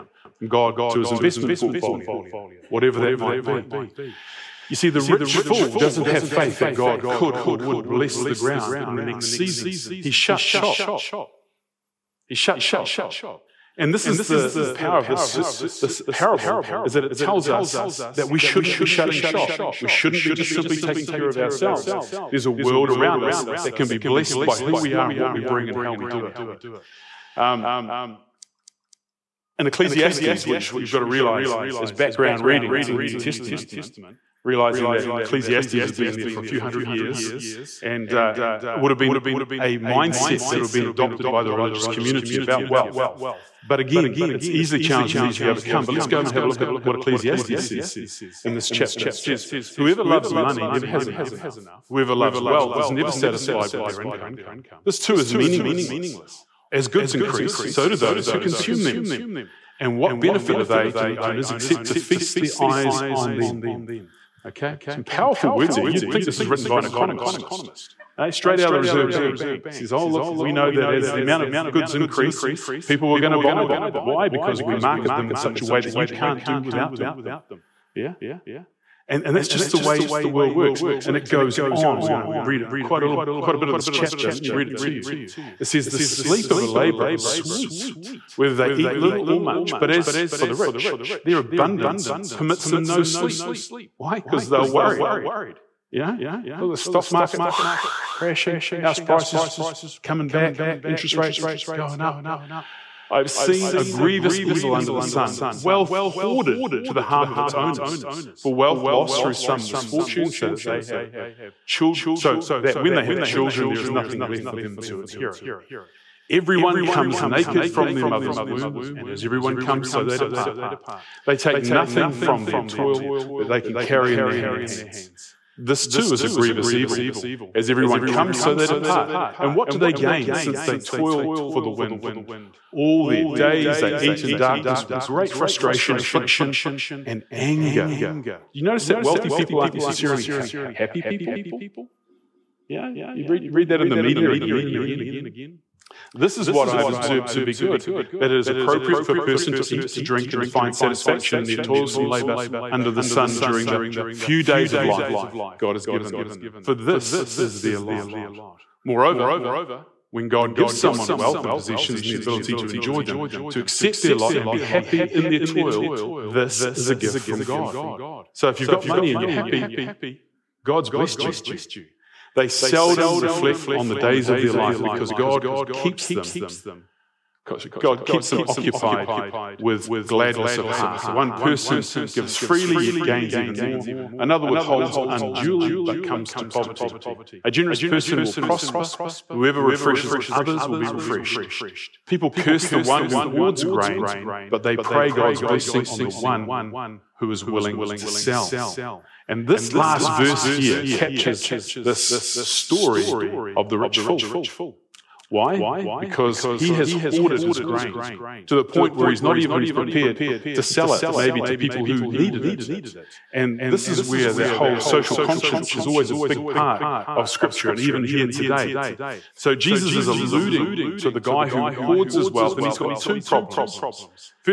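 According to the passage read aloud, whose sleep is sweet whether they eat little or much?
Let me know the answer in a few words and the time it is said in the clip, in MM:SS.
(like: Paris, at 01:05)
a laborer, at 01:26.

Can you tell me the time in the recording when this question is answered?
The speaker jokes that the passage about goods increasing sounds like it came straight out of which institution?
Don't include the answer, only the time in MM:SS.
01:08.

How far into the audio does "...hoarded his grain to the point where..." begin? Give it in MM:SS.
03:26.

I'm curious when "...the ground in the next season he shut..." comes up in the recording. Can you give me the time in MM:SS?
00:08.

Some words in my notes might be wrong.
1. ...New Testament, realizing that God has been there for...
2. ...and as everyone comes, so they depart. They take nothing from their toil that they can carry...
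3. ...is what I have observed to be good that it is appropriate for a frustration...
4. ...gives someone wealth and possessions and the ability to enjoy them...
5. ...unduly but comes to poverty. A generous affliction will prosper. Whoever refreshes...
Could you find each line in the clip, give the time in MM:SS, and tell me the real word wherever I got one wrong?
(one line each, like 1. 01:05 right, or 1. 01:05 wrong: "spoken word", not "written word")
1. 00:32 wrong: "Ecclesiastes", not "God"
2. 01:58 right
3. 02:26 wrong: "person", not "frustration"
4. 02:40 right
5. 03:05 wrong: "person", not "affliction".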